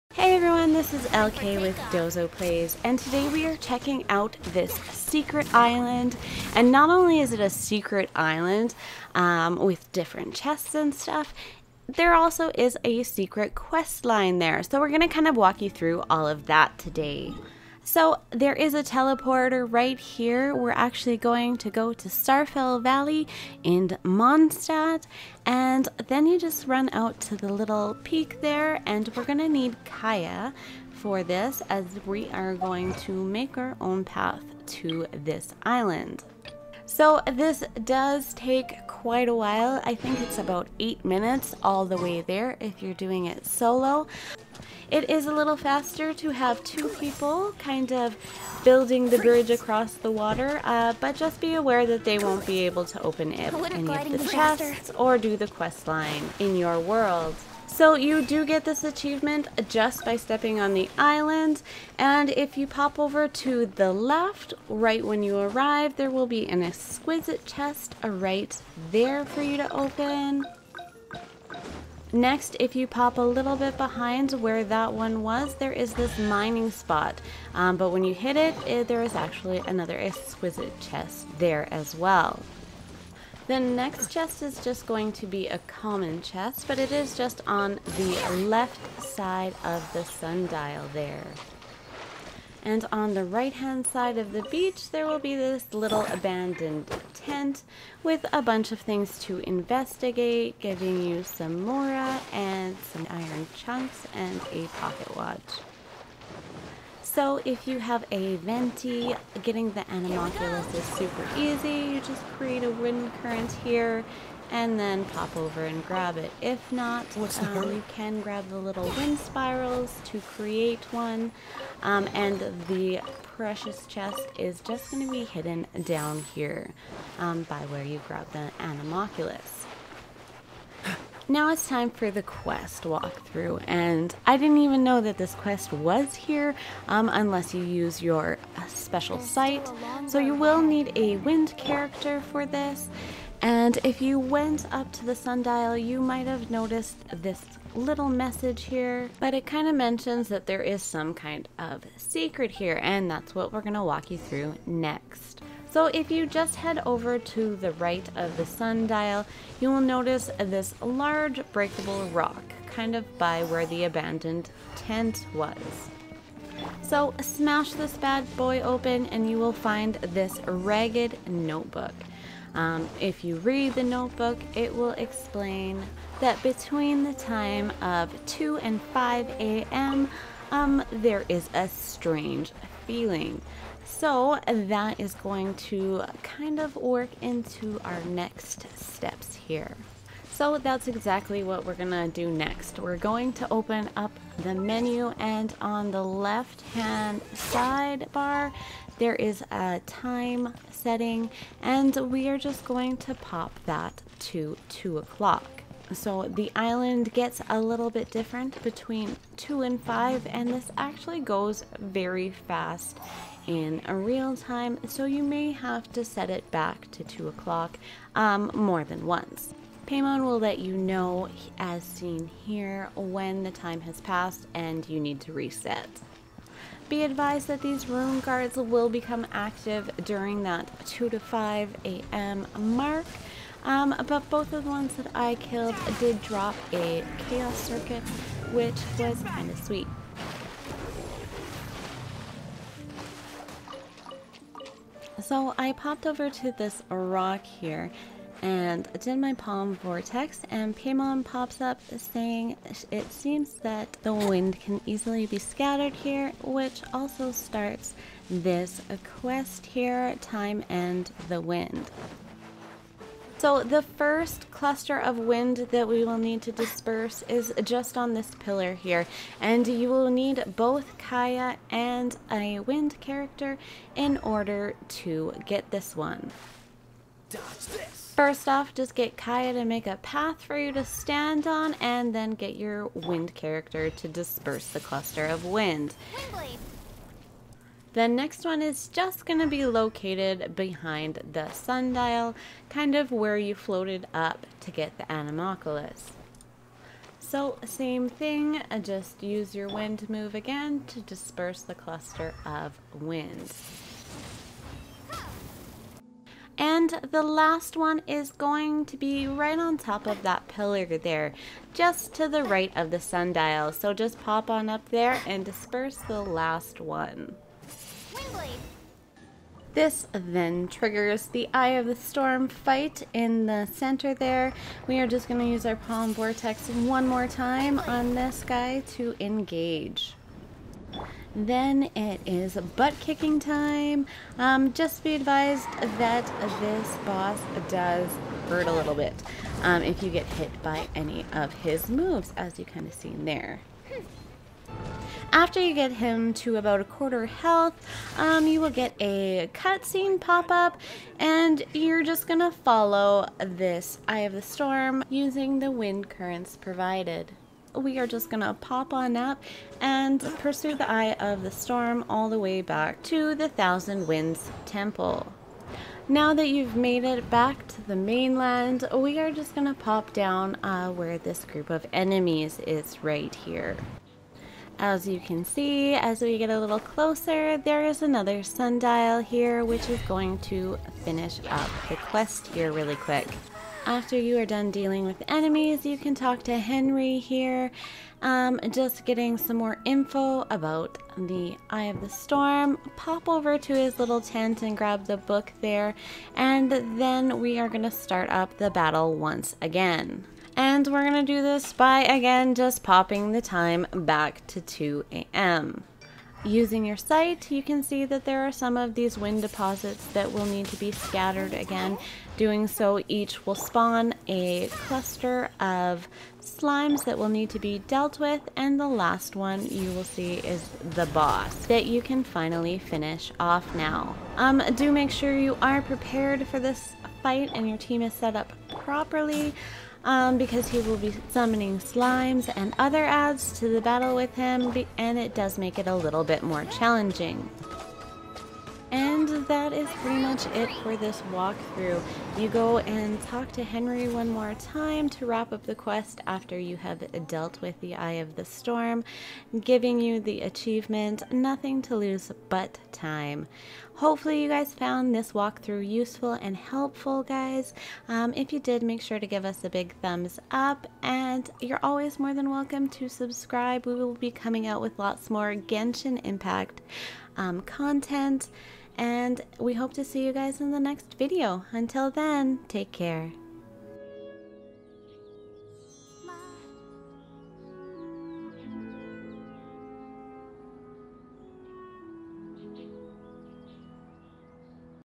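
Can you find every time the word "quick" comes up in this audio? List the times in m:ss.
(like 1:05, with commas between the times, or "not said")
6:22.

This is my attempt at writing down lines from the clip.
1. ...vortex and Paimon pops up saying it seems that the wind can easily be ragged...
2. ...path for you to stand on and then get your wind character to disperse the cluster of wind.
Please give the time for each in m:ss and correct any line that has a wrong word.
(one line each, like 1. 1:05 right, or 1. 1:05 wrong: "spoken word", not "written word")
1. 4:09 wrong: "scattered", not "ragged"
2. 4:39 right.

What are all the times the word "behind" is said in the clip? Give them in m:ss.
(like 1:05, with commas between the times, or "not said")
1:13, 4:50.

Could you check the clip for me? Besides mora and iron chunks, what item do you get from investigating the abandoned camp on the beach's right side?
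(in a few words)
pocket watch.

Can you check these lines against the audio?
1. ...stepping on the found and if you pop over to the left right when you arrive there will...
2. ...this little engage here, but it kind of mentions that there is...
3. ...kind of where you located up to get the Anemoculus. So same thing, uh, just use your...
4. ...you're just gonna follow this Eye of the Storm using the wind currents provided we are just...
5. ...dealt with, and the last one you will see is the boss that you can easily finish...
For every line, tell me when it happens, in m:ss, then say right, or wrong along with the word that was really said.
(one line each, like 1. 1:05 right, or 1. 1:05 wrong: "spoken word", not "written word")
1. 1:00 wrong: "island", not "found"
2. 2:27 wrong: "message", not "engage"
3. 4:52 wrong: "floated", not "located"
4. 5:51 right
5. 6:57 wrong: "finally", not "easily".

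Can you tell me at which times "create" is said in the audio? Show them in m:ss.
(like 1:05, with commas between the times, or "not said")
1:52, 2:00.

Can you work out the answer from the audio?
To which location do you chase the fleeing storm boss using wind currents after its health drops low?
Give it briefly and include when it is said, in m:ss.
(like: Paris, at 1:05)
Thousand Winds Temple, at 6:03.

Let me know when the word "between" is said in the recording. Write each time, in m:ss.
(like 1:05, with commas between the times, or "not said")
2:56, 3:28.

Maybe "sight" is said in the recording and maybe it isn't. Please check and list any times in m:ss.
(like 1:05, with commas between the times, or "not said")
2:19, 6:46.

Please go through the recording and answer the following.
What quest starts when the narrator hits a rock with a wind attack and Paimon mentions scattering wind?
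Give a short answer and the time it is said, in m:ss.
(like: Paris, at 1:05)
Time and the Wind, at 4:20.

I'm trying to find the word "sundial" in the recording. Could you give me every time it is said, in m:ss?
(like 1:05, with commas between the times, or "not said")
1:30, 2:25, 2:38, 4:51, 5:12, 6:18.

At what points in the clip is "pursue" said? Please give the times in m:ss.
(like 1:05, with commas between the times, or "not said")
6:00.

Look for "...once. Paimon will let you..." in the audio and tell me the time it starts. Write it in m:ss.
3:39.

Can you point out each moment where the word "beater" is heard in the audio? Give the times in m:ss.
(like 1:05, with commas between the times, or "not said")
not said.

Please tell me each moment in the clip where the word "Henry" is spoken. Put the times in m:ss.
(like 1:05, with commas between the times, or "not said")
6:26, 7:23.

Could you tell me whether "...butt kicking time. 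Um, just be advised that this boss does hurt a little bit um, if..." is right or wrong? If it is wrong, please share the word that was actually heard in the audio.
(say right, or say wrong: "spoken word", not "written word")
right.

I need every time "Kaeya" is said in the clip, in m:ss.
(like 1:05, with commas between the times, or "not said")
0:29, 4:30, 4:39.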